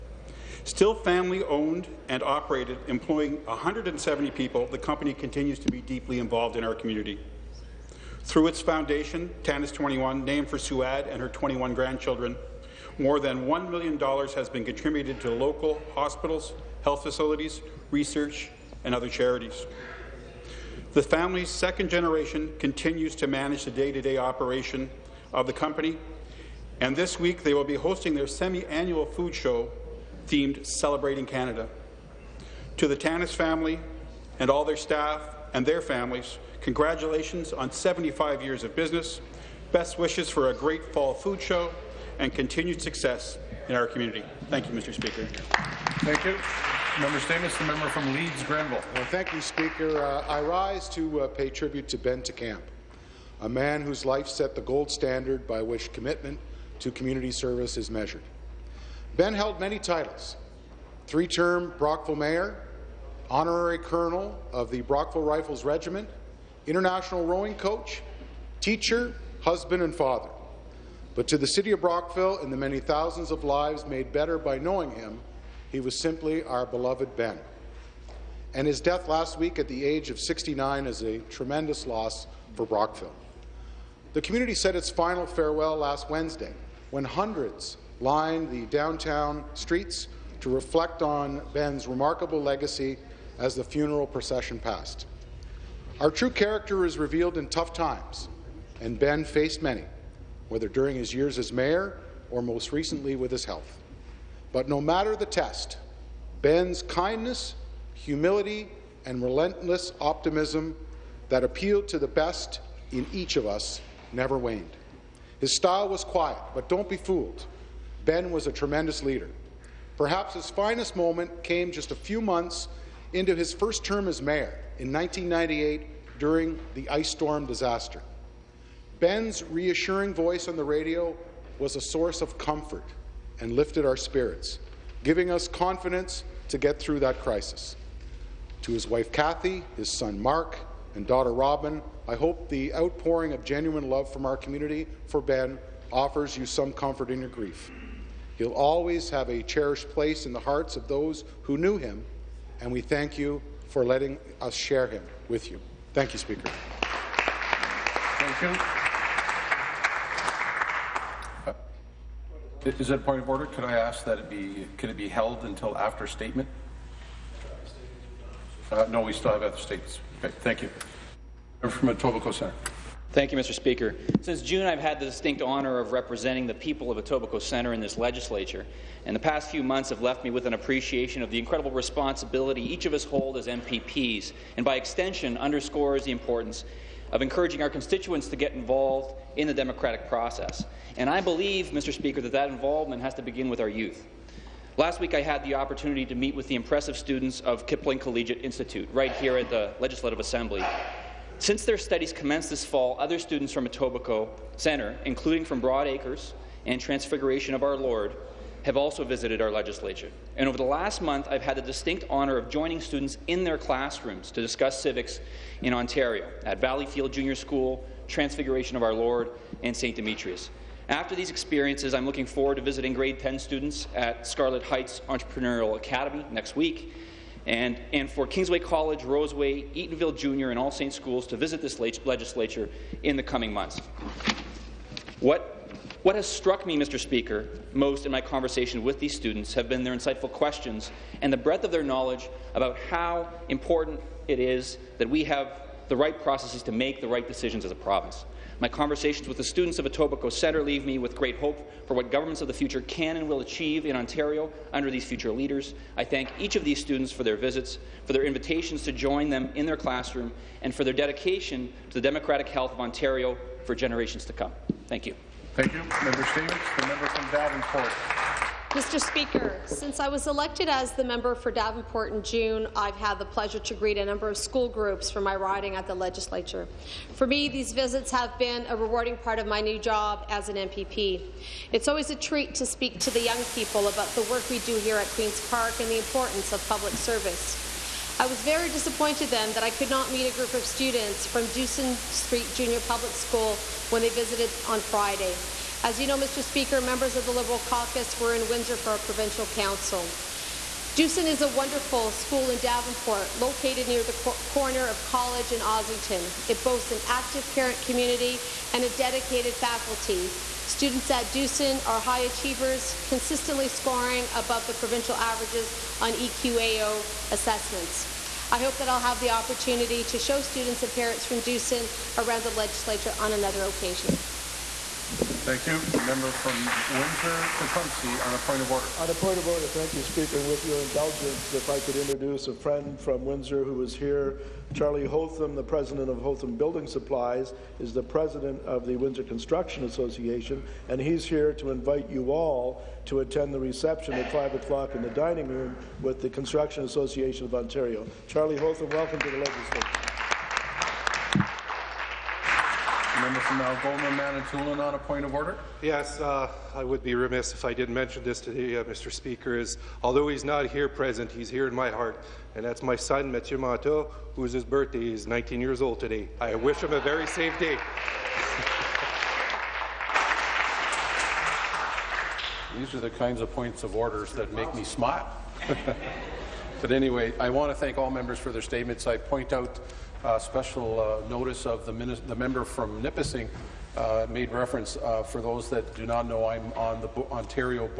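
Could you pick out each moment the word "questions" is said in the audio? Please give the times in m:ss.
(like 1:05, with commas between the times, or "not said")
4:00.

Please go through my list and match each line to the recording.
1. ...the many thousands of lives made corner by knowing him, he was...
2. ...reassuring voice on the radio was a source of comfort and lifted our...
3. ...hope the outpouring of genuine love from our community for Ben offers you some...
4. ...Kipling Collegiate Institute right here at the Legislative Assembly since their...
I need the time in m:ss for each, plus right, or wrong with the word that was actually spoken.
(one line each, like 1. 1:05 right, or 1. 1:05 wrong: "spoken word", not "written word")
1. 1:12 wrong: "better", not "corner"
2. 2:09 right
3. 2:22 right
4. 3:17 right.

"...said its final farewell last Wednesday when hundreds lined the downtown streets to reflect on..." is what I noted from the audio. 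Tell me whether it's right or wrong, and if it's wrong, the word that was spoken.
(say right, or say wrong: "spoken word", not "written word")
right.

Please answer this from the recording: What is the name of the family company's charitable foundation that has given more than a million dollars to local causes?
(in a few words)
TANNIS 21.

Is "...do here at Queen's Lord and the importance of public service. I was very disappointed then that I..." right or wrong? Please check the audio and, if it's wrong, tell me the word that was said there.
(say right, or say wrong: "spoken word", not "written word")
wrong: "Park", not "Lord".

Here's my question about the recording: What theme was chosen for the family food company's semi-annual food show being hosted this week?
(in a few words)
Celebrating Canada.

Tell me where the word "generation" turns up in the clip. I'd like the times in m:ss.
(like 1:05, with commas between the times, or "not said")
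0:21, 4:23.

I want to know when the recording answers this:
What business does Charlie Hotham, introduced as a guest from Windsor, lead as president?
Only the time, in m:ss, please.
5:36.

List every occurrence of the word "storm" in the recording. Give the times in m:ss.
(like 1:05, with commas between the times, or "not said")
2:07.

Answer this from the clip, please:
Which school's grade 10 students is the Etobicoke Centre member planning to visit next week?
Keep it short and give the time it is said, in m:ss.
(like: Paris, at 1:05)
Scarlett Heights Entrepreneurial Academy, at 3:44.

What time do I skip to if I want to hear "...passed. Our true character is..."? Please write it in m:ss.
1:34.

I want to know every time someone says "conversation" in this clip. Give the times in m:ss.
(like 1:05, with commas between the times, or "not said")
3:58, 4:08.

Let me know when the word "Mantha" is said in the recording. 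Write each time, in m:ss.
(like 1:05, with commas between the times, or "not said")
6:03.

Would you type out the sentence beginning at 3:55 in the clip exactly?
What, what has struck me, Mr.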